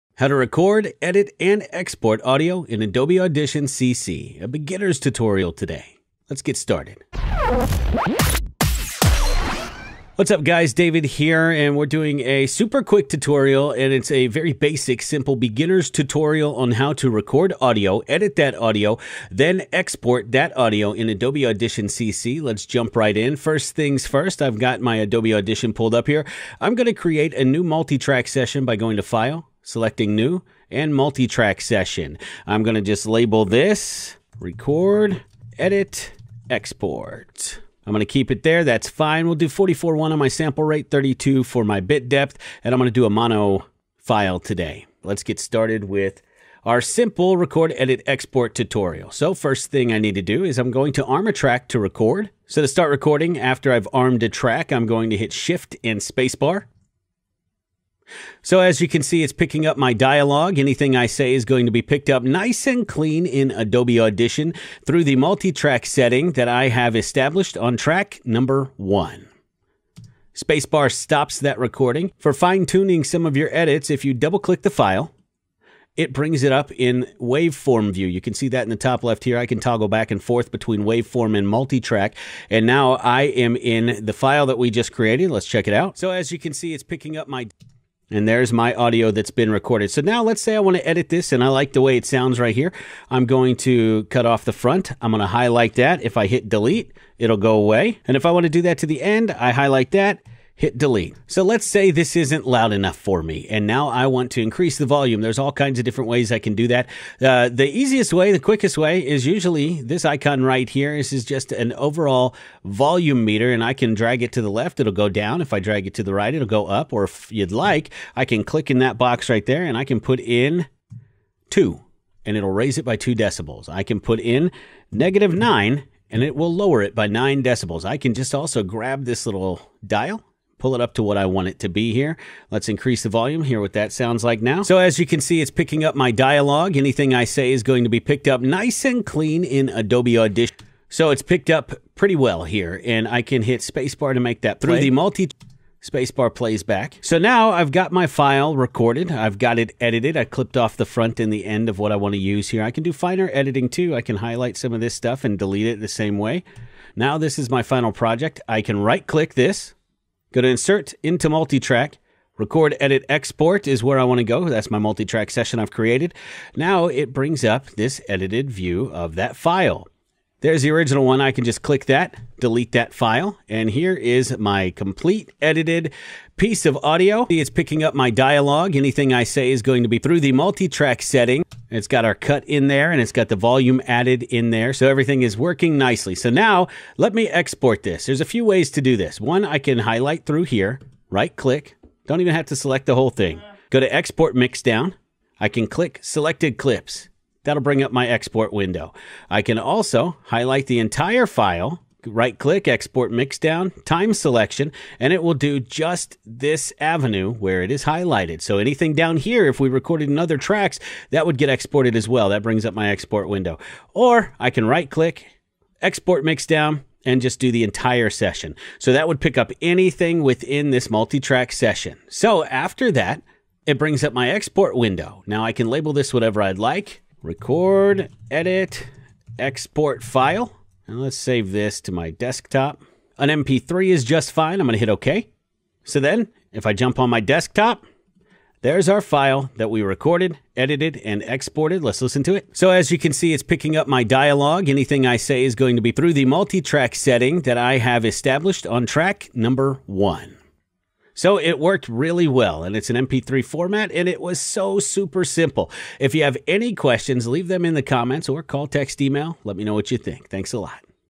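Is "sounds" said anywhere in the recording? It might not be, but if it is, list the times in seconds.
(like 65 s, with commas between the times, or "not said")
92 s, 133 s.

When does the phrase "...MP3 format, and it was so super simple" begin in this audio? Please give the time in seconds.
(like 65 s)
252 s.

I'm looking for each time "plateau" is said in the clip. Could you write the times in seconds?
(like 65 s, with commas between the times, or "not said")
not said.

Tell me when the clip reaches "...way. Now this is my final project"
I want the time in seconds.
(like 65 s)
156 s.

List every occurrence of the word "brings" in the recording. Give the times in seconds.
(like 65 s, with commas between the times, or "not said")
76 s, 167 s, 197 s, 212 s, 223 s.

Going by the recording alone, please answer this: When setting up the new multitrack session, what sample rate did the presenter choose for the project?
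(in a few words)
44.1.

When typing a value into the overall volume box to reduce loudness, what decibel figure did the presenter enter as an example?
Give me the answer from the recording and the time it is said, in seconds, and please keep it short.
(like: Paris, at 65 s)
-9, at 124 s.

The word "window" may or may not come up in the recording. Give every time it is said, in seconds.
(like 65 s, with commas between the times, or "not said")
198 s, 213 s, 224 s.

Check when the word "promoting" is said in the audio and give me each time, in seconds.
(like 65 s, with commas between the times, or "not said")
not said.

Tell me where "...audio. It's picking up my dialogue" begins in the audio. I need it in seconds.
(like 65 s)
176 s.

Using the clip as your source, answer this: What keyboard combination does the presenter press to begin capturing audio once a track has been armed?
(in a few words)
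Shift and spacebar.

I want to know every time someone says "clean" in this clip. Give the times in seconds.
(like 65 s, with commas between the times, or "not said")
62 s, 139 s.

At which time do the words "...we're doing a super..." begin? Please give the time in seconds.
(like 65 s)
11 s.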